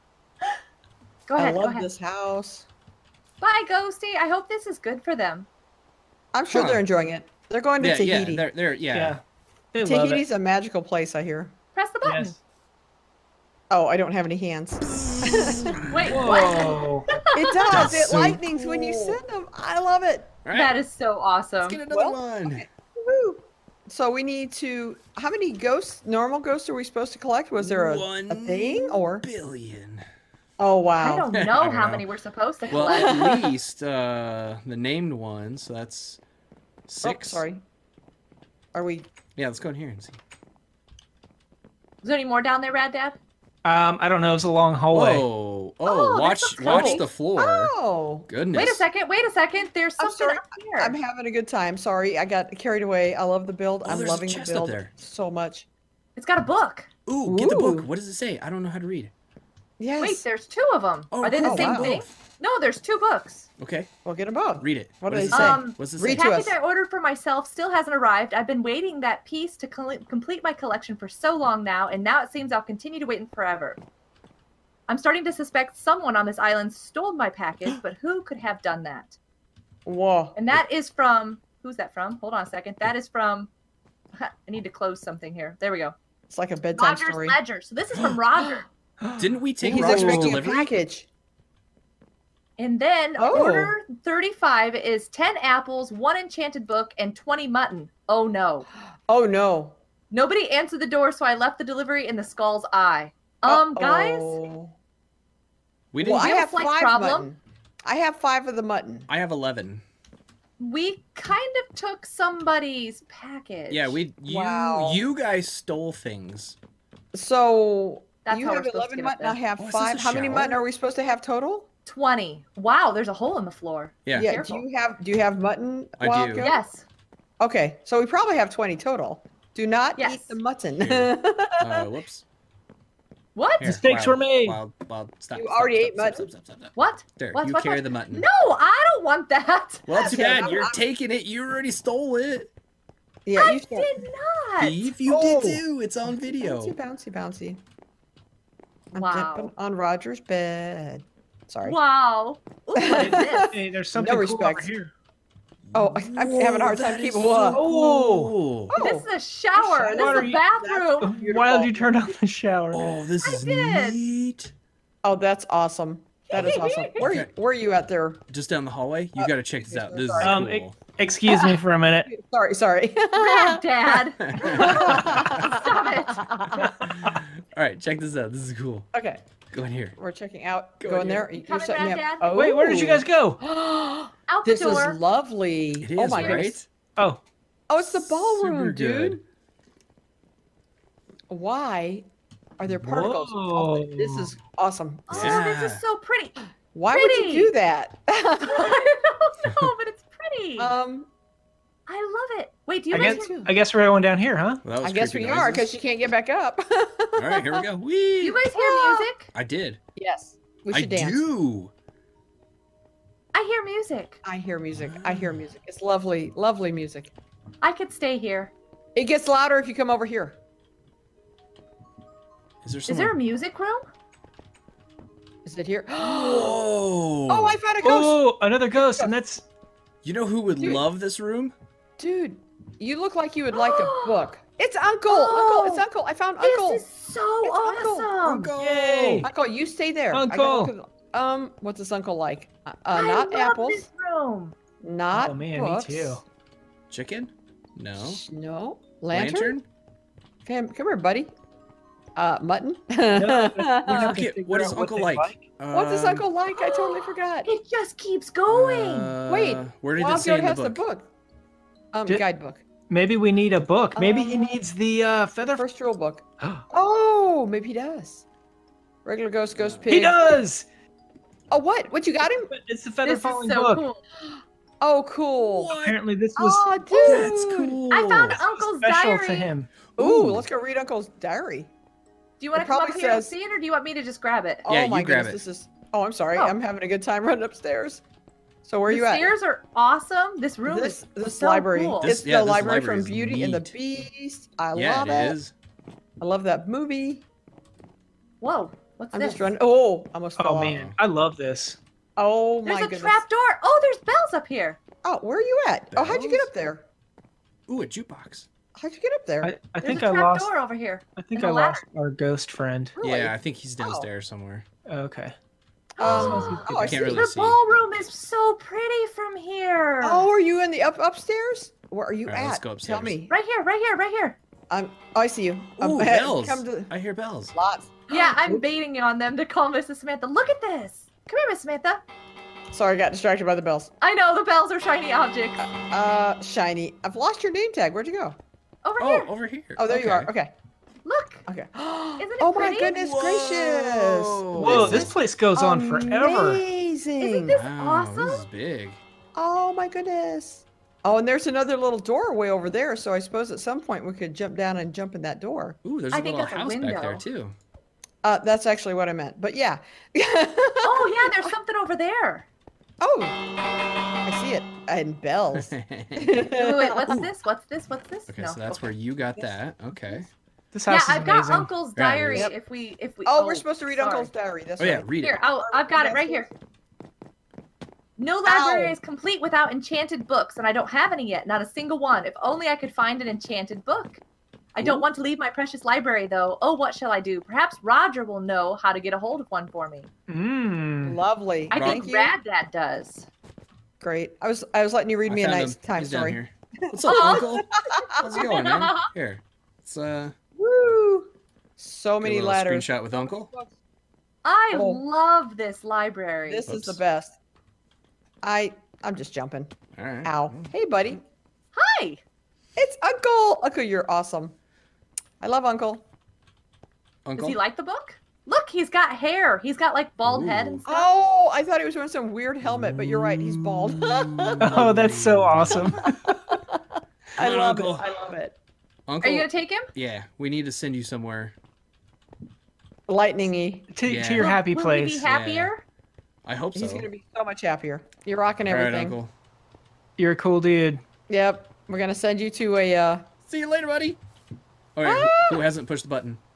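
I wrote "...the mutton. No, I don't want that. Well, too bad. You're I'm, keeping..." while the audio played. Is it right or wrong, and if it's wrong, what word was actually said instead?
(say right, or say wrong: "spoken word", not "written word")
wrong: "taking", not "keeping".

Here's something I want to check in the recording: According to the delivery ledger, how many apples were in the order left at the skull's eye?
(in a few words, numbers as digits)
10.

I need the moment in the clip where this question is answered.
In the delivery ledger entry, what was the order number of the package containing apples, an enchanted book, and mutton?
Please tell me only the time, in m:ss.
1:33.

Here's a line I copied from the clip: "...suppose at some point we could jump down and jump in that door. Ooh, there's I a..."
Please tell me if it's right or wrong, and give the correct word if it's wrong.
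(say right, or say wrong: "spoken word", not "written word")
right.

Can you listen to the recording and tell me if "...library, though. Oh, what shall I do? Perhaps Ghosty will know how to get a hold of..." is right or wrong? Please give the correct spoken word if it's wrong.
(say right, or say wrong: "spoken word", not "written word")
wrong: "Roger", not "Ghosty".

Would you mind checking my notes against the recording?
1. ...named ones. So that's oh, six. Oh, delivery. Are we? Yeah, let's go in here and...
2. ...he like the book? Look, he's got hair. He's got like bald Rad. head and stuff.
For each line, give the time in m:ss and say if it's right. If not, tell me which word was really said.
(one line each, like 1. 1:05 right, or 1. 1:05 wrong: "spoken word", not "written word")
1. 0:34 wrong: "sorry", not "delivery"
2. 6:57 wrong: "Ooh", not "Rad".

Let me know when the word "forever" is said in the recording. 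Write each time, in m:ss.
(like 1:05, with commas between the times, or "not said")
1:13, 5:46.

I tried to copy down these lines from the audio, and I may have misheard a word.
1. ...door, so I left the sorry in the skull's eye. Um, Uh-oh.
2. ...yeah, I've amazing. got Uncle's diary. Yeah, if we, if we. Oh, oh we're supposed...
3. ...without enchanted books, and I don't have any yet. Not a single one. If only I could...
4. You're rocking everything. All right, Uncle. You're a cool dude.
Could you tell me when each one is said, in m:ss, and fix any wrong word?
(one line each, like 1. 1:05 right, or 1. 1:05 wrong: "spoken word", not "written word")
1. 1:40 wrong: "delivery", not "sorry"
2. 6:11 right
3. 6:19 right
4. 7:18 right.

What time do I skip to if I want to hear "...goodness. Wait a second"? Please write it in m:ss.
0:48.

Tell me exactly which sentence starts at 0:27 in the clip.
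Was there a, one a thing or billion?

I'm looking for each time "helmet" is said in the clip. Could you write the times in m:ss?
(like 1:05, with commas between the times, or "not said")
7:02.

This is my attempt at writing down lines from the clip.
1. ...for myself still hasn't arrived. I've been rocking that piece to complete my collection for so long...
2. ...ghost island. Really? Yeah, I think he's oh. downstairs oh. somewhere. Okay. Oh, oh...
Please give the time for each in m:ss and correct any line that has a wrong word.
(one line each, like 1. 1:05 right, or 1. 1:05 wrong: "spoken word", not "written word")
1. 1:06 wrong: "waiting", not "rocking"
2. 5:12 wrong: "friend", not "island".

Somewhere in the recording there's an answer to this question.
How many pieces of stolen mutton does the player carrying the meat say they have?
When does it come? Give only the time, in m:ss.
1:49.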